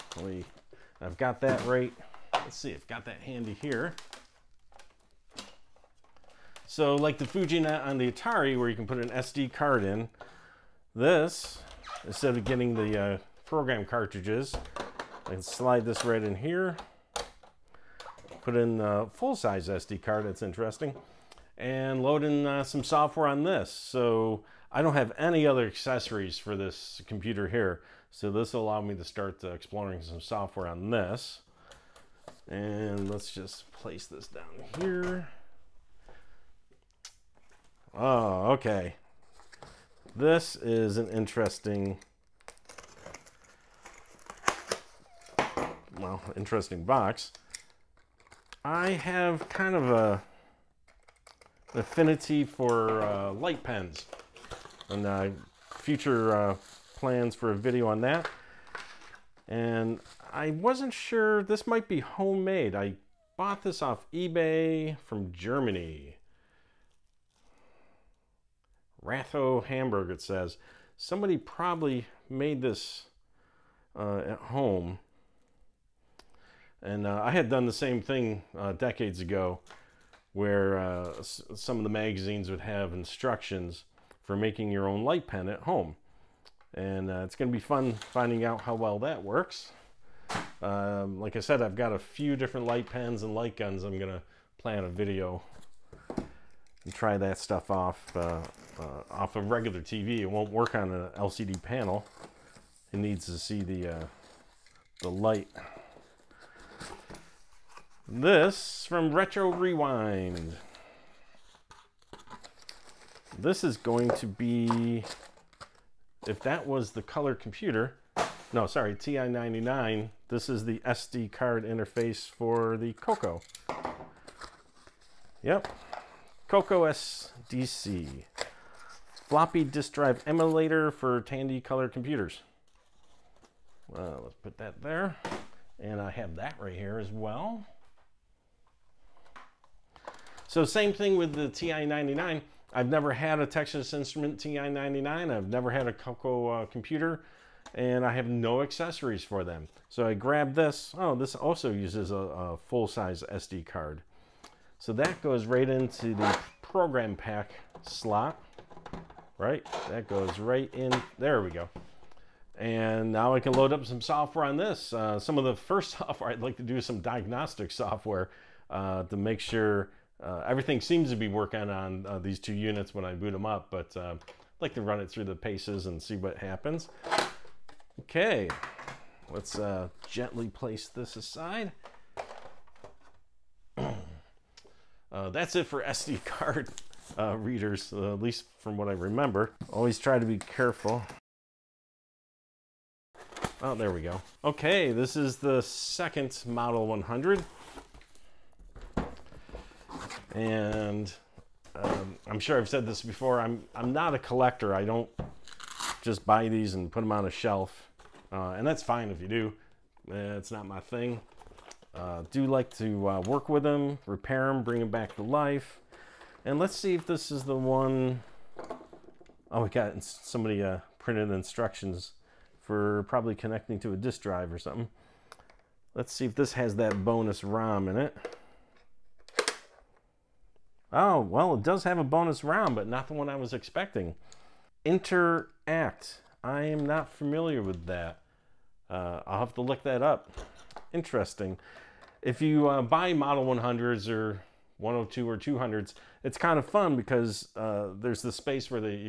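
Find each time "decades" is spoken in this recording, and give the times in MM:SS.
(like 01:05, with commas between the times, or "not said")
01:18.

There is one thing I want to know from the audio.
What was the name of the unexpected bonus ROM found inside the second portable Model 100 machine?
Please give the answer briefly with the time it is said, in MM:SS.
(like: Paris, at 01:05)
Interact, at 03:54.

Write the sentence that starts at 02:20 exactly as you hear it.
So same thing with the TI-99.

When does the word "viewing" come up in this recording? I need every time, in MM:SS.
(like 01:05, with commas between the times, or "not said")
not said.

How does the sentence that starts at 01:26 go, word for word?
And uh, it's going to be fun finding out how well that works.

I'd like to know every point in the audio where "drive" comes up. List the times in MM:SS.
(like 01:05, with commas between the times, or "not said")
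02:09, 03:44.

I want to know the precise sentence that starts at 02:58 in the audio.
Okay, let's uh, gently place this aside.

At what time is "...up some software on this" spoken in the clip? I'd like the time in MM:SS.
02:43.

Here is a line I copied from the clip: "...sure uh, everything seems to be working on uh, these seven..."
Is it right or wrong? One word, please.
wrong.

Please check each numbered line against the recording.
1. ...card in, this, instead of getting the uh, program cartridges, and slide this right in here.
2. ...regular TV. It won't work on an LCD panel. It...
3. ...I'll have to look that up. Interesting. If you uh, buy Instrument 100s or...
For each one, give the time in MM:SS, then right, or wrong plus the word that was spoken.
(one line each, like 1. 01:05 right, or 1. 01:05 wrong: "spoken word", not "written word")
1. 00:09 right
2. 01:39 right
3. 03:59 wrong: "Model", not "Instrument".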